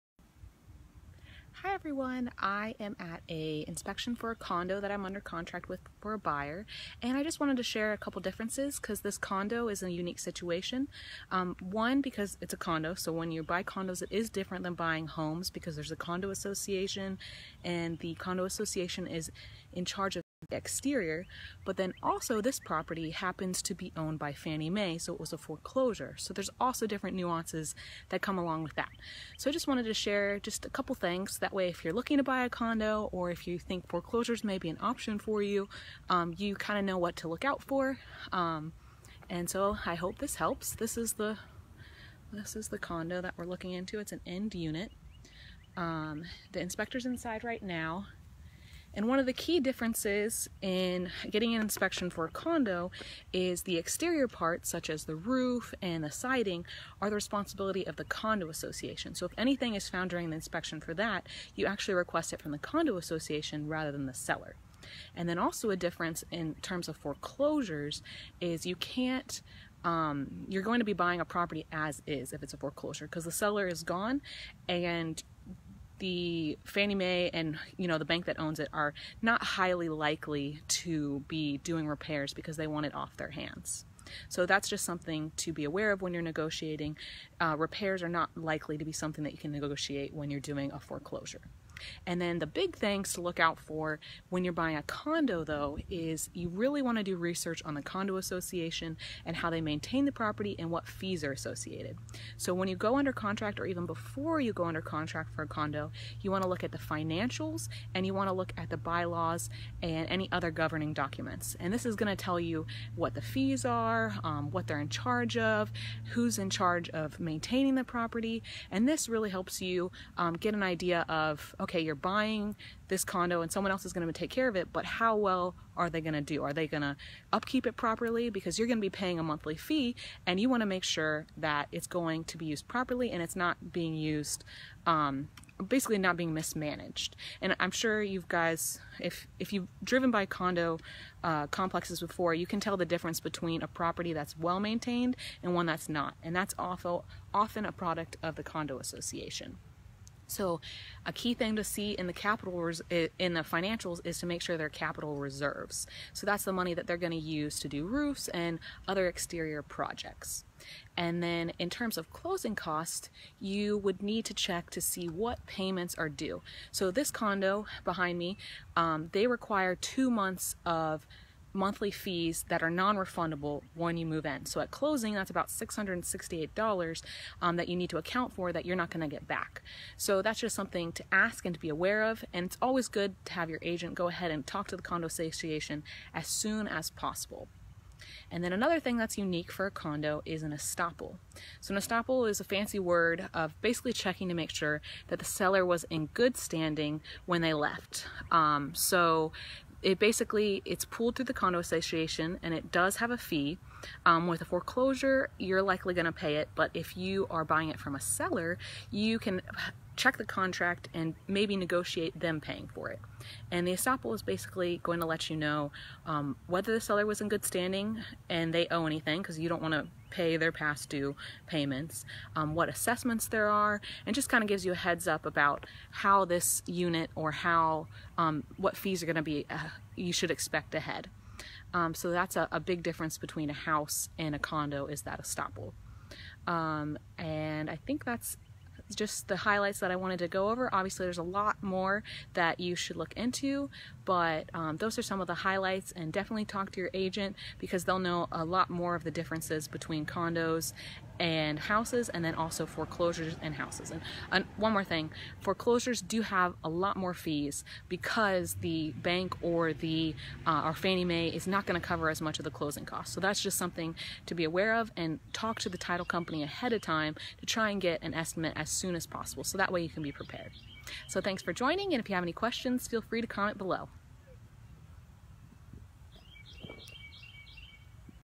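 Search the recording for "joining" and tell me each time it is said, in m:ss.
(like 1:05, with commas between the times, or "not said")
4:31.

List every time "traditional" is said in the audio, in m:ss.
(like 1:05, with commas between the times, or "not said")
not said.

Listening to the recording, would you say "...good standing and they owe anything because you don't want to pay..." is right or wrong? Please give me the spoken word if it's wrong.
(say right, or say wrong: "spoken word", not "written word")
right.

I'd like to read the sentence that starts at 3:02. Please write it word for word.
And it's always good to have your agent go ahead and talk to the condo association as soon as possible.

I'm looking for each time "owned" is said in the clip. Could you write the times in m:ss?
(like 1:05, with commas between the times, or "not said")
0:23.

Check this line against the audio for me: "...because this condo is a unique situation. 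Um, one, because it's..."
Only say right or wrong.
right.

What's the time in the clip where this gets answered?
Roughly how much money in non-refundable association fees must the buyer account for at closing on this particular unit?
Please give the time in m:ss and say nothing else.
2:55.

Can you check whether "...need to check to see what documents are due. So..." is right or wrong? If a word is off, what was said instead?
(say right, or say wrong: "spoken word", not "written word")
wrong: "payments", not "documents".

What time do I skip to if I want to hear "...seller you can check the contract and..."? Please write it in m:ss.
3:28.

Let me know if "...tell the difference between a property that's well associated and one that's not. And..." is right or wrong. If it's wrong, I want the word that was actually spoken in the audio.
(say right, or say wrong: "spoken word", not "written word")
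wrong: "maintained", not "associated".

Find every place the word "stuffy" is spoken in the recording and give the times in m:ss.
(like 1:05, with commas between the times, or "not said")
not said.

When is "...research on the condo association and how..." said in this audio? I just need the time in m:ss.
1:37.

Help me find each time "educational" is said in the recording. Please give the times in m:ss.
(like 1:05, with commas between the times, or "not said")
not said.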